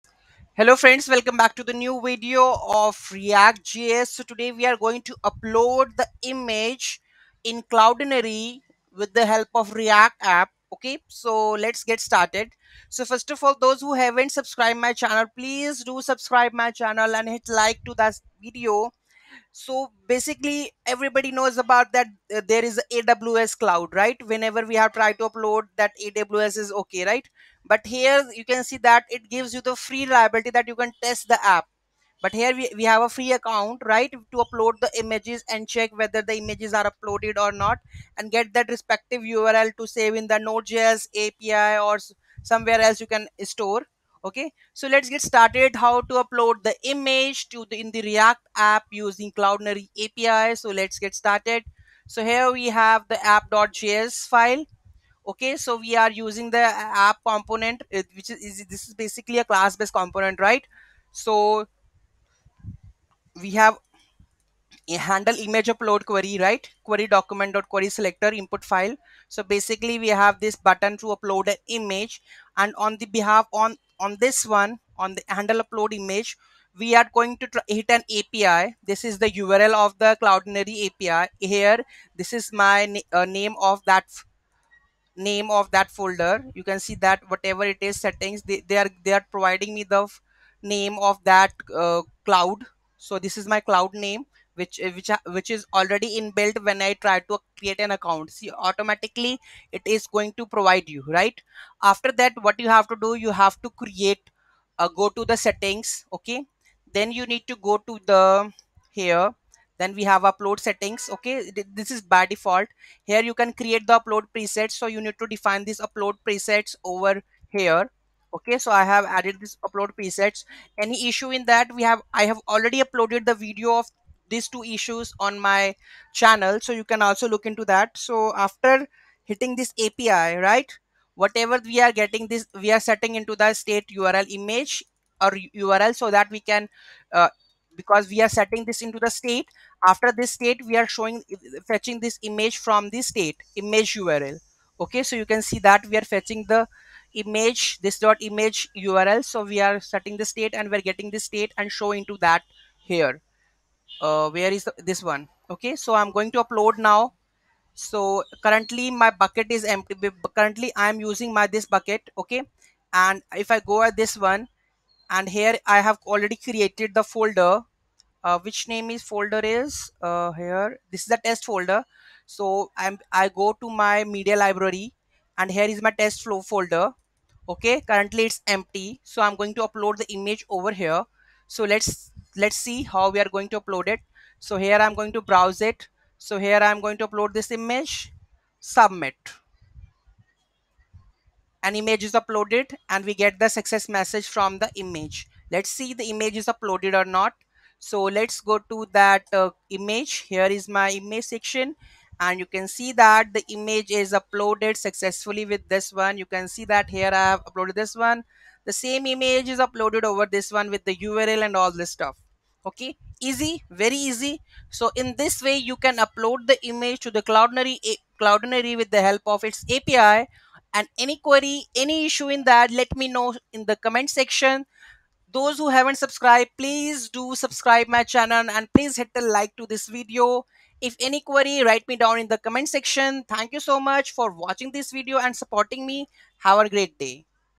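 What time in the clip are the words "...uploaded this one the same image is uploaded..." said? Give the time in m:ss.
3:27.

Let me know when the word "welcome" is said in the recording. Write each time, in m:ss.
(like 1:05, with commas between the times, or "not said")
0:01.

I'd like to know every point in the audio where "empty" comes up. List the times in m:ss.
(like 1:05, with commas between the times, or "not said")
2:39, 2:58.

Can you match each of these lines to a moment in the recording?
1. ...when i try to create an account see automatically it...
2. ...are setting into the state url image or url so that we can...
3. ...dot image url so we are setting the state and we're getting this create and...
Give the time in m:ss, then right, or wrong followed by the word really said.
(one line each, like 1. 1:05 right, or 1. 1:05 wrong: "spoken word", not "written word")
1. 1:36 right
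2. 2:12 right
3. 2:27 wrong: "state", not "create".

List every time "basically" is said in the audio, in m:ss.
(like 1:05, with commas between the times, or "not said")
0:20, 0:58, 1:09.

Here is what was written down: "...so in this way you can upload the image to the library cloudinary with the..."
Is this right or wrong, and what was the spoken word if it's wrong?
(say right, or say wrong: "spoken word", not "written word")
wrong: "cloudinary", not "library".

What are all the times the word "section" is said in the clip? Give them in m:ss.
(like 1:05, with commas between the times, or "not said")
3:21, 3:44, 3:52.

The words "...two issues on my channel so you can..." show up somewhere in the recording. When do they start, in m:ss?
2:04.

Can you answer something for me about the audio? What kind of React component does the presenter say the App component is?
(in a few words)
class based component.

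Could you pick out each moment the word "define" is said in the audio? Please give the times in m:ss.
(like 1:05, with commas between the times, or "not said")
1:55.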